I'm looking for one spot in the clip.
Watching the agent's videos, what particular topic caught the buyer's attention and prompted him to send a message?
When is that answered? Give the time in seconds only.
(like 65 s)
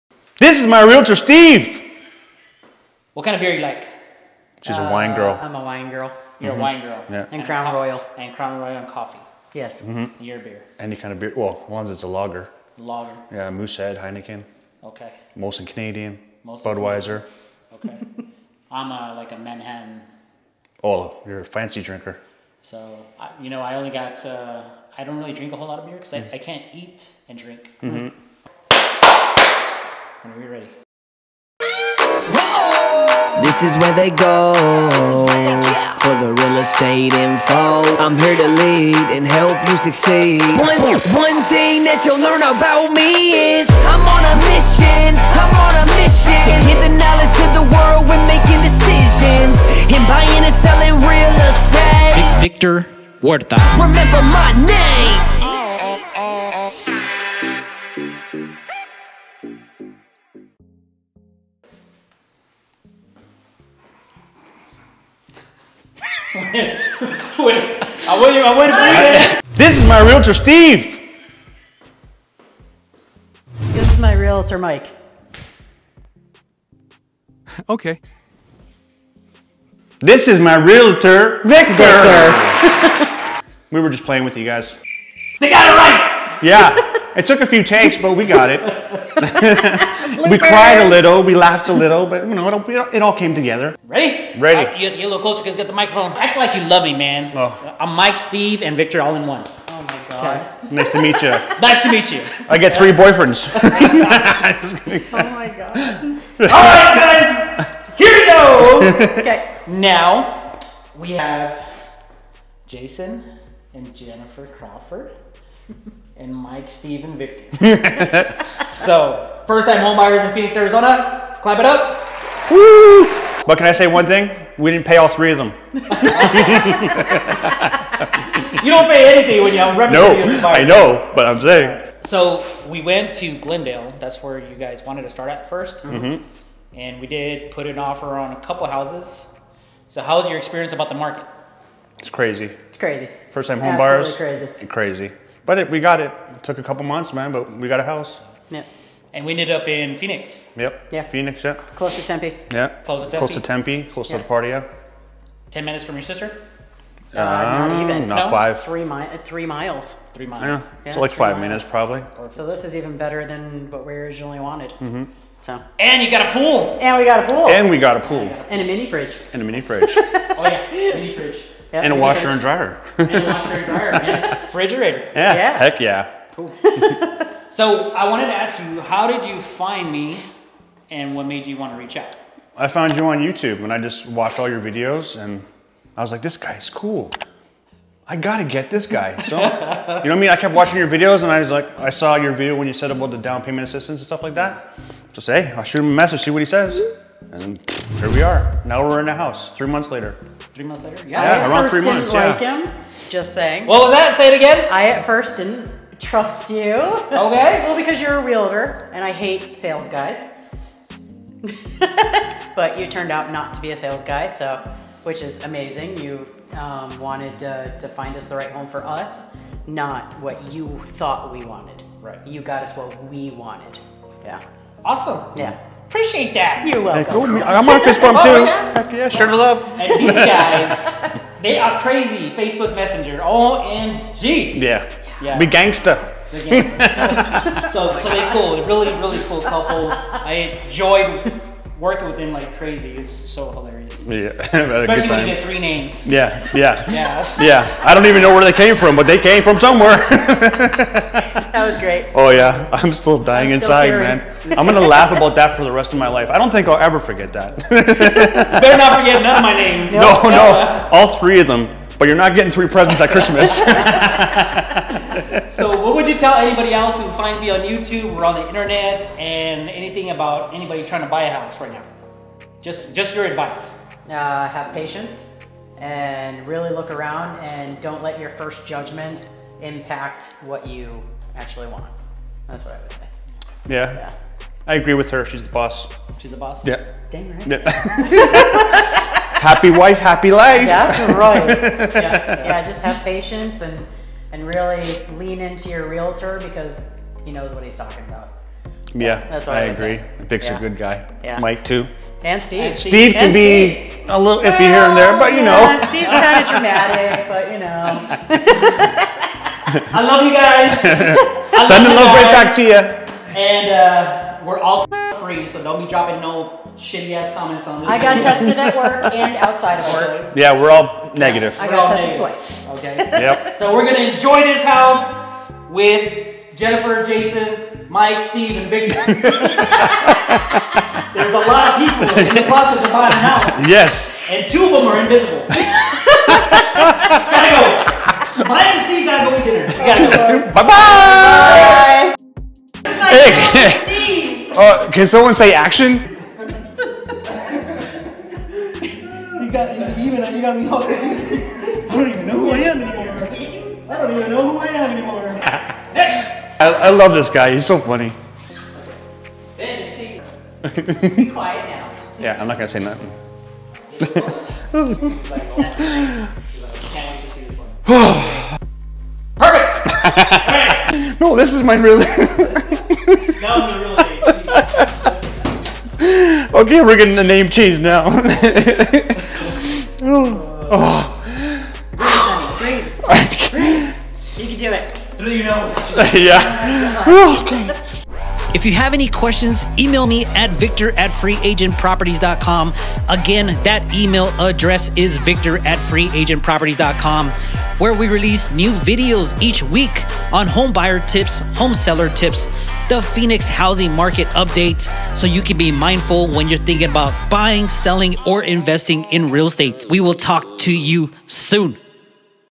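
193 s.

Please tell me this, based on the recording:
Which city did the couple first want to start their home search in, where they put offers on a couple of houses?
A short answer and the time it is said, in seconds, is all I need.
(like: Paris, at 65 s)
Glendale, at 133 s.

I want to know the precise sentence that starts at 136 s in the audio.
and we did put an offer on a couple houses.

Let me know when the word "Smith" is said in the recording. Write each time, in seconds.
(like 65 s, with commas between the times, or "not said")
not said.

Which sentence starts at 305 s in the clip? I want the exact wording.
Steve's kind of dramatic, but you know.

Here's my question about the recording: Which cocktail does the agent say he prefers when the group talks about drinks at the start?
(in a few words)
Manhattan.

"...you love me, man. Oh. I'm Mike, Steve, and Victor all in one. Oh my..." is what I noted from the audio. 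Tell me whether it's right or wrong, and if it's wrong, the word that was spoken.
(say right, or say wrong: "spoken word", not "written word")
right.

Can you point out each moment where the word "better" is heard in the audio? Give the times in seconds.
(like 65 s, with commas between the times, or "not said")
162 s, 257 s.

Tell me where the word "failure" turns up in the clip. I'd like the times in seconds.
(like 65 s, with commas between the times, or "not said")
not said.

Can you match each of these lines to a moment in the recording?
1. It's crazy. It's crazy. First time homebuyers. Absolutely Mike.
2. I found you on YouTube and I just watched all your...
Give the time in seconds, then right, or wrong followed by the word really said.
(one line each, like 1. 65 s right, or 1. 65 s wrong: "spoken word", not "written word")
1. 141 s wrong: "Crazy", not "Mike"
2. 182 s right.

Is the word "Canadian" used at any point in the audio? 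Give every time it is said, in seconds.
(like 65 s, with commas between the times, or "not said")
15 s.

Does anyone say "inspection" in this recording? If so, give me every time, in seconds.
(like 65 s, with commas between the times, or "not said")
not said.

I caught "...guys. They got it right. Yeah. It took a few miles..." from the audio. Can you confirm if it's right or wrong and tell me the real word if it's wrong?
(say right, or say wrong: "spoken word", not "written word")
wrong: "takes", not "miles".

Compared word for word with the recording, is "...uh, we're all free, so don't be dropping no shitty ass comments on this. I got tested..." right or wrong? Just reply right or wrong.
right.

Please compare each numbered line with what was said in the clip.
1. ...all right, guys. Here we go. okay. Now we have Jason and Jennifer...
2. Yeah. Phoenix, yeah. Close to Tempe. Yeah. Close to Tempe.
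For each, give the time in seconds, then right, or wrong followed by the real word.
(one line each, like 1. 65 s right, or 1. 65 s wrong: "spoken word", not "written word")
1. 106 s right
2. 150 s right.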